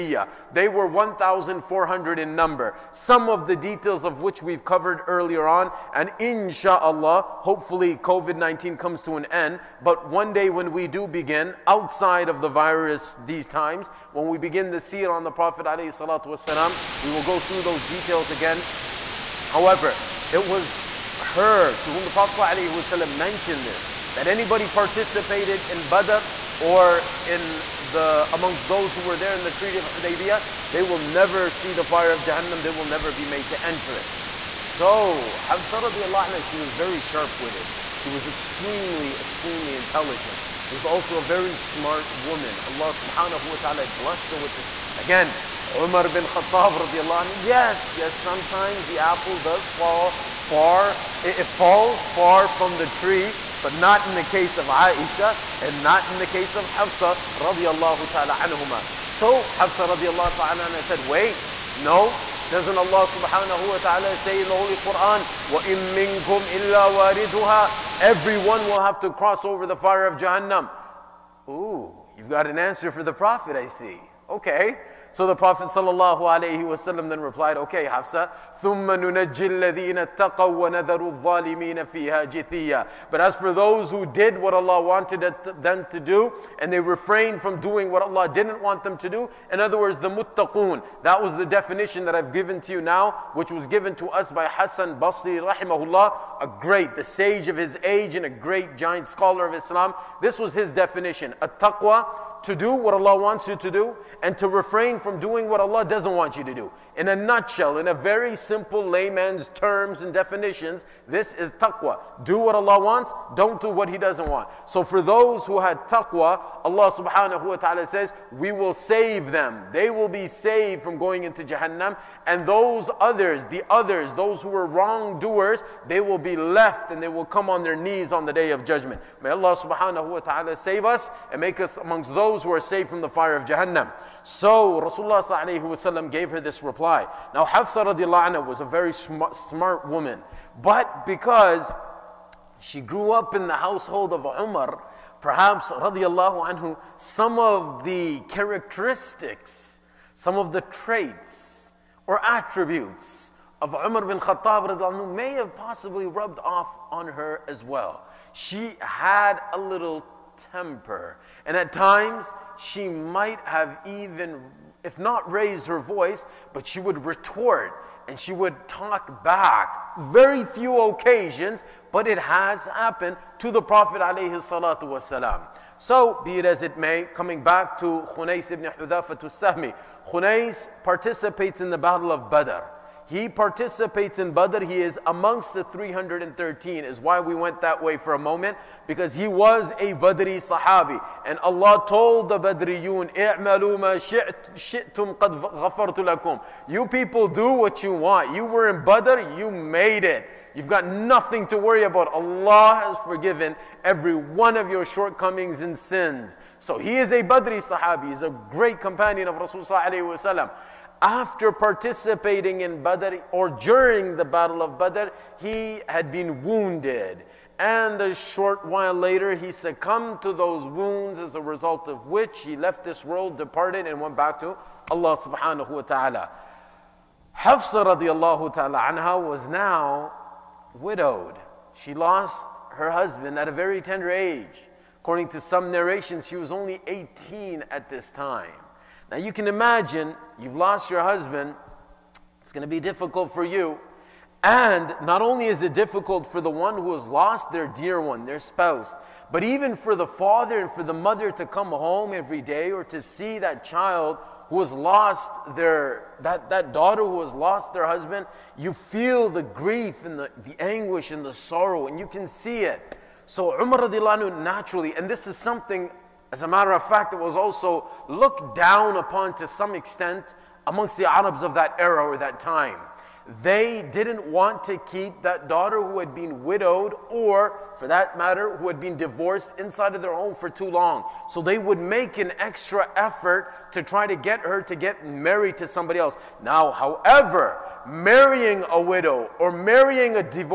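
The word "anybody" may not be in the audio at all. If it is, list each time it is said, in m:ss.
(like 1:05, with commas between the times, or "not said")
0:24.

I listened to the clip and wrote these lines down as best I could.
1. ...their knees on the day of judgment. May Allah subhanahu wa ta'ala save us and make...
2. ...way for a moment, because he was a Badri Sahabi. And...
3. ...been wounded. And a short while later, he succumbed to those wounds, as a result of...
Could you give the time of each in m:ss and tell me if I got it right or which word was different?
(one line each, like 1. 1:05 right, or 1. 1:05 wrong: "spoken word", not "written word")
1. 2:07 right
2. 3:07 right
3. 3:36 right.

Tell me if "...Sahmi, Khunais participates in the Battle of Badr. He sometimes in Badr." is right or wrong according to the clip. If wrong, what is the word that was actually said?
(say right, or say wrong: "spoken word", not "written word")
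wrong: "participates", not "sometimes".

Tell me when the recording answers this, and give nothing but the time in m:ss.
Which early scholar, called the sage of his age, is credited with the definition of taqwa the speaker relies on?
1:34.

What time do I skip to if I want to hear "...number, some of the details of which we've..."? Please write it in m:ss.
0:02.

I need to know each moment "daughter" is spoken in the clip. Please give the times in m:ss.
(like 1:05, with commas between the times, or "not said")
4:16, 4:35.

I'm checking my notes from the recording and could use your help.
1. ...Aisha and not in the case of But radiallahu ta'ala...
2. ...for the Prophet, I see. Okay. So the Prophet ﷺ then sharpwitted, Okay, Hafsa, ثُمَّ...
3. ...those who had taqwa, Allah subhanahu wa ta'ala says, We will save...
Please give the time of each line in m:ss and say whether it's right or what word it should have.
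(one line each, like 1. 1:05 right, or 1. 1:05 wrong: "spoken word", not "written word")
1. 0:54 wrong: "Hafsa", not "But"
2. 1:12 wrong: "replied", not "sharpwitted"
3. 1:55 right.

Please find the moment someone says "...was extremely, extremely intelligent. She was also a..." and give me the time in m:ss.
0:38.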